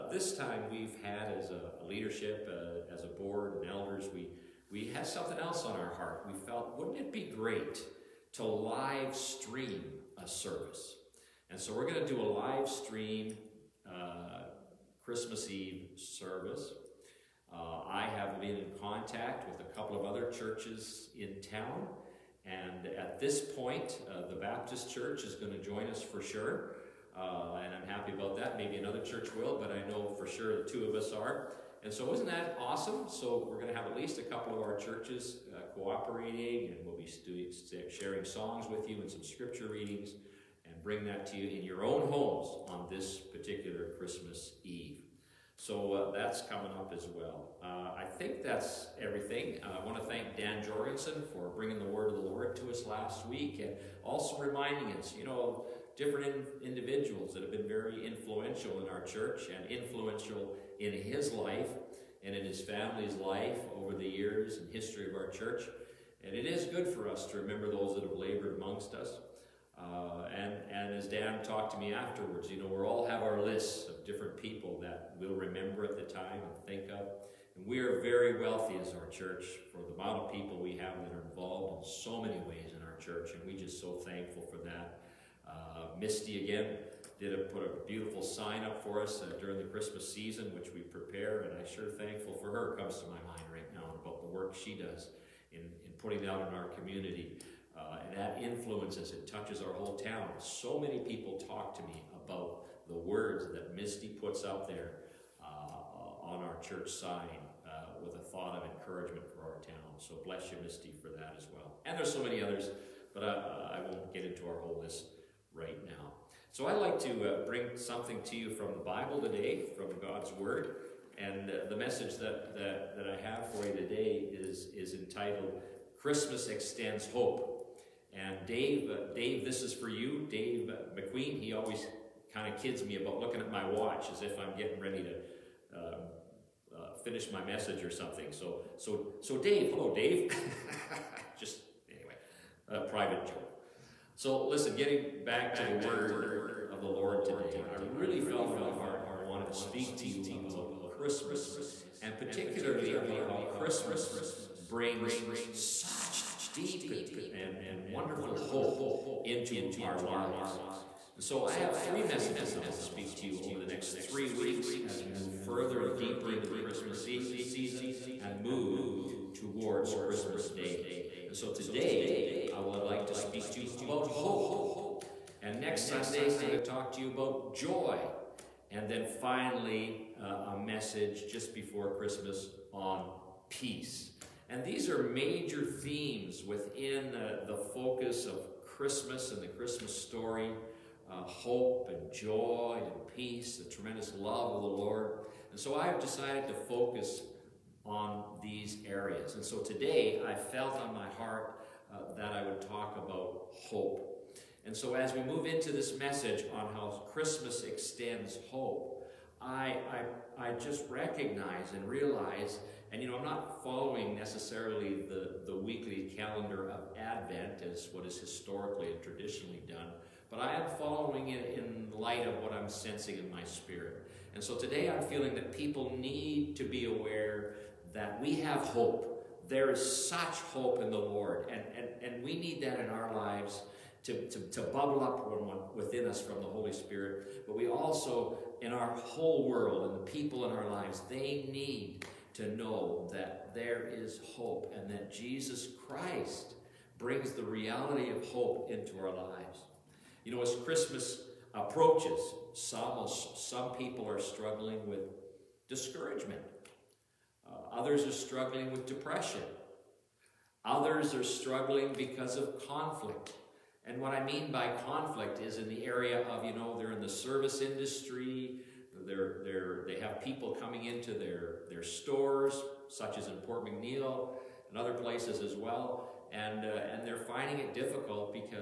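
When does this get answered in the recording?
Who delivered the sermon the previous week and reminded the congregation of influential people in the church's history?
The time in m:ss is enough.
0:50.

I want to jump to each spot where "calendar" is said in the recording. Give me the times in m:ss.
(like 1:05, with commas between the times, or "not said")
3:36.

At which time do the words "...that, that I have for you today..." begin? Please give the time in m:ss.
2:02.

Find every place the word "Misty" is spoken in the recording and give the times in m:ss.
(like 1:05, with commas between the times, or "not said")
1:26, 1:43, 1:50.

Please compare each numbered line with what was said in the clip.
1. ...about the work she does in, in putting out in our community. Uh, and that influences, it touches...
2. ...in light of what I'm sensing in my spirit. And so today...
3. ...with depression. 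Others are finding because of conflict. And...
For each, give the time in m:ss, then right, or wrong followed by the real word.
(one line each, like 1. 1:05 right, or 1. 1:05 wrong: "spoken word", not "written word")
1. 1:34 right
2. 3:41 right
3. 4:18 wrong: "struggling", not "finding".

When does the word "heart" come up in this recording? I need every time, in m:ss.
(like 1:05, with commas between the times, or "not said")
0:05, 2:28, 3:21.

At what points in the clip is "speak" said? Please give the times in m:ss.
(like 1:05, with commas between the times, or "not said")
2:29, 2:42, 2:53.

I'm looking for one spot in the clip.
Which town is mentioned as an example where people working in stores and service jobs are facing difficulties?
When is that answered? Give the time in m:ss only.
4:33.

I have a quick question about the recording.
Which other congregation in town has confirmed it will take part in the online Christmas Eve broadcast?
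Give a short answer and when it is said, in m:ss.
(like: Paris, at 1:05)
The Baptist Church, at 0:24.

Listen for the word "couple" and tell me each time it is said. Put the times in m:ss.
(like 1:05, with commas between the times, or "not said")
0:19, 0:34.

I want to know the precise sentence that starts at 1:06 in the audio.
And it is good for us to remember those that have labored amongst us.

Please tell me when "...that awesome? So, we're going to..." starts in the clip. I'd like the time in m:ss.
0:32.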